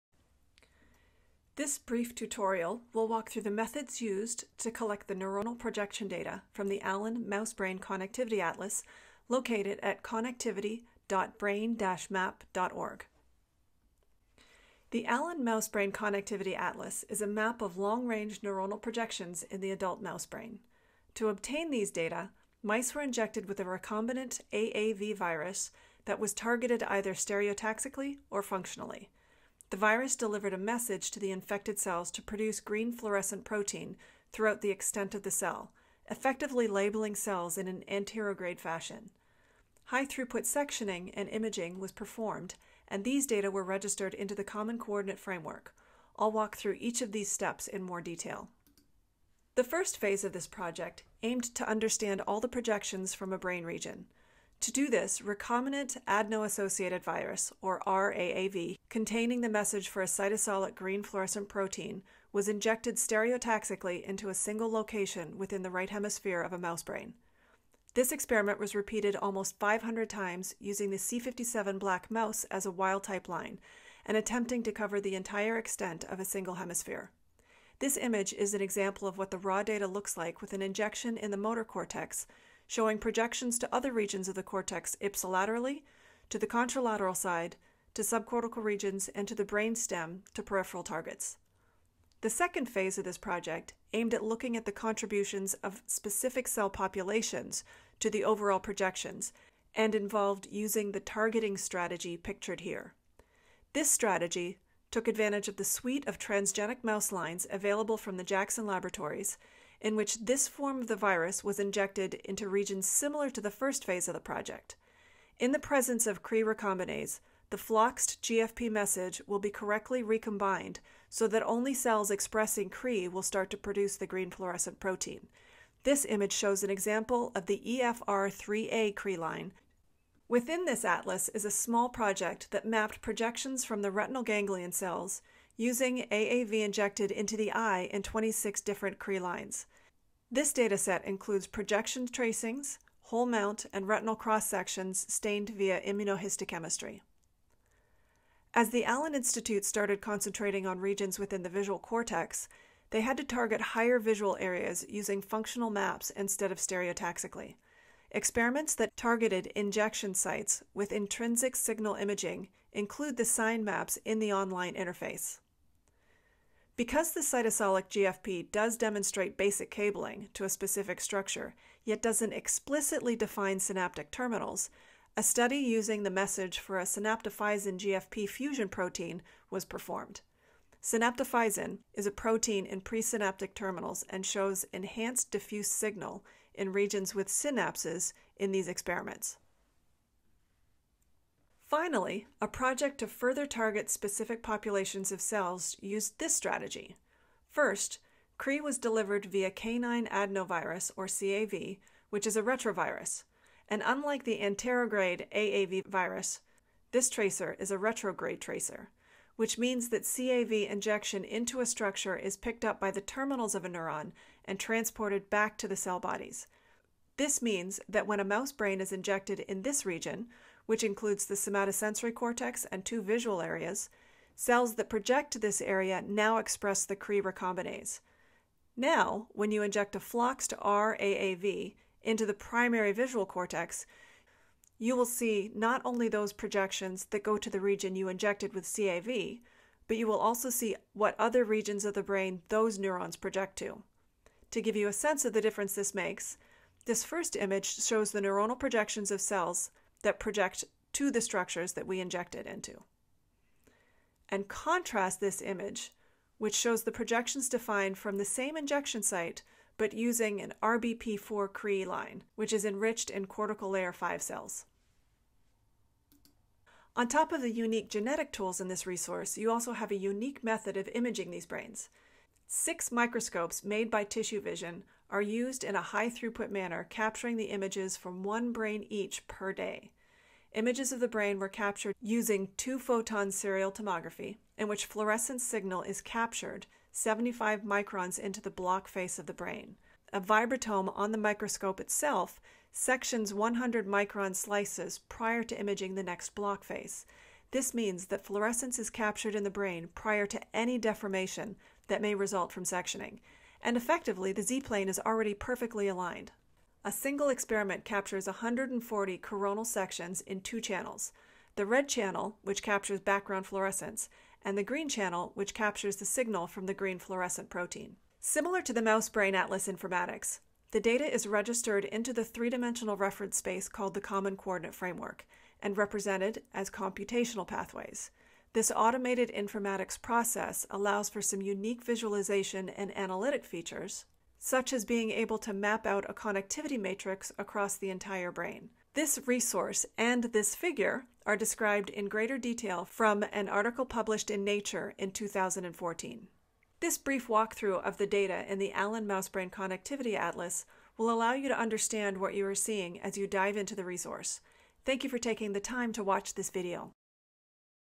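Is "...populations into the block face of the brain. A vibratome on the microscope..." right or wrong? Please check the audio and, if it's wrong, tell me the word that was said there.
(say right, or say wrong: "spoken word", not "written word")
wrong: "microns", not "populations".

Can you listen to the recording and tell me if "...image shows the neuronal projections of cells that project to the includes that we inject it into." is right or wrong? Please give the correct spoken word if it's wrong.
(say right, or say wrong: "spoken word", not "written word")
wrong: "structures", not "includes".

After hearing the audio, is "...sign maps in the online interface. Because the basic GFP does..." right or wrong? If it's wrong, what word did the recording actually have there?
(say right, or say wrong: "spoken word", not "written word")
wrong: "cytosolic", not "basic".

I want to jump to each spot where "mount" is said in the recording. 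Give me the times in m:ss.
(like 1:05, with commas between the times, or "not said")
2:23.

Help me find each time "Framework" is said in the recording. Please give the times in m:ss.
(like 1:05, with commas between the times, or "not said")
0:45, 5:24.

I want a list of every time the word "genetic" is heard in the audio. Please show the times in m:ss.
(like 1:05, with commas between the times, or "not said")
4:27.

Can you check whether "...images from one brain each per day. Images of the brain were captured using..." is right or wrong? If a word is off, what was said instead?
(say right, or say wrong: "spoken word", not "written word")
right.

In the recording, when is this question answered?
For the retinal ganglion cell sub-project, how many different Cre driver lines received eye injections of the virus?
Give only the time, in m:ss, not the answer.
2:18.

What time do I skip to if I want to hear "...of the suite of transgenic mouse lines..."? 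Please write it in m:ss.
1:45.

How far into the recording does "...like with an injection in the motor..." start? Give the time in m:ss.
1:20.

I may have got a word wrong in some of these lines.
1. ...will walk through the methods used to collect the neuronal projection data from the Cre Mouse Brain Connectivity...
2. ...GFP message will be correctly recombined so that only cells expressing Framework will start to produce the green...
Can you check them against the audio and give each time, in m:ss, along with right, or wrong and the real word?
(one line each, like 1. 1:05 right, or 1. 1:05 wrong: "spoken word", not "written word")
1. 0:02 wrong: "Allen", not "Cre"
2. 1:58 wrong: "Cre", not "Framework".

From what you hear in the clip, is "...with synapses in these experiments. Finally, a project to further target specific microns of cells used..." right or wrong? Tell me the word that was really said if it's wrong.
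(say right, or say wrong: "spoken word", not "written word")
wrong: "populations", not "microns".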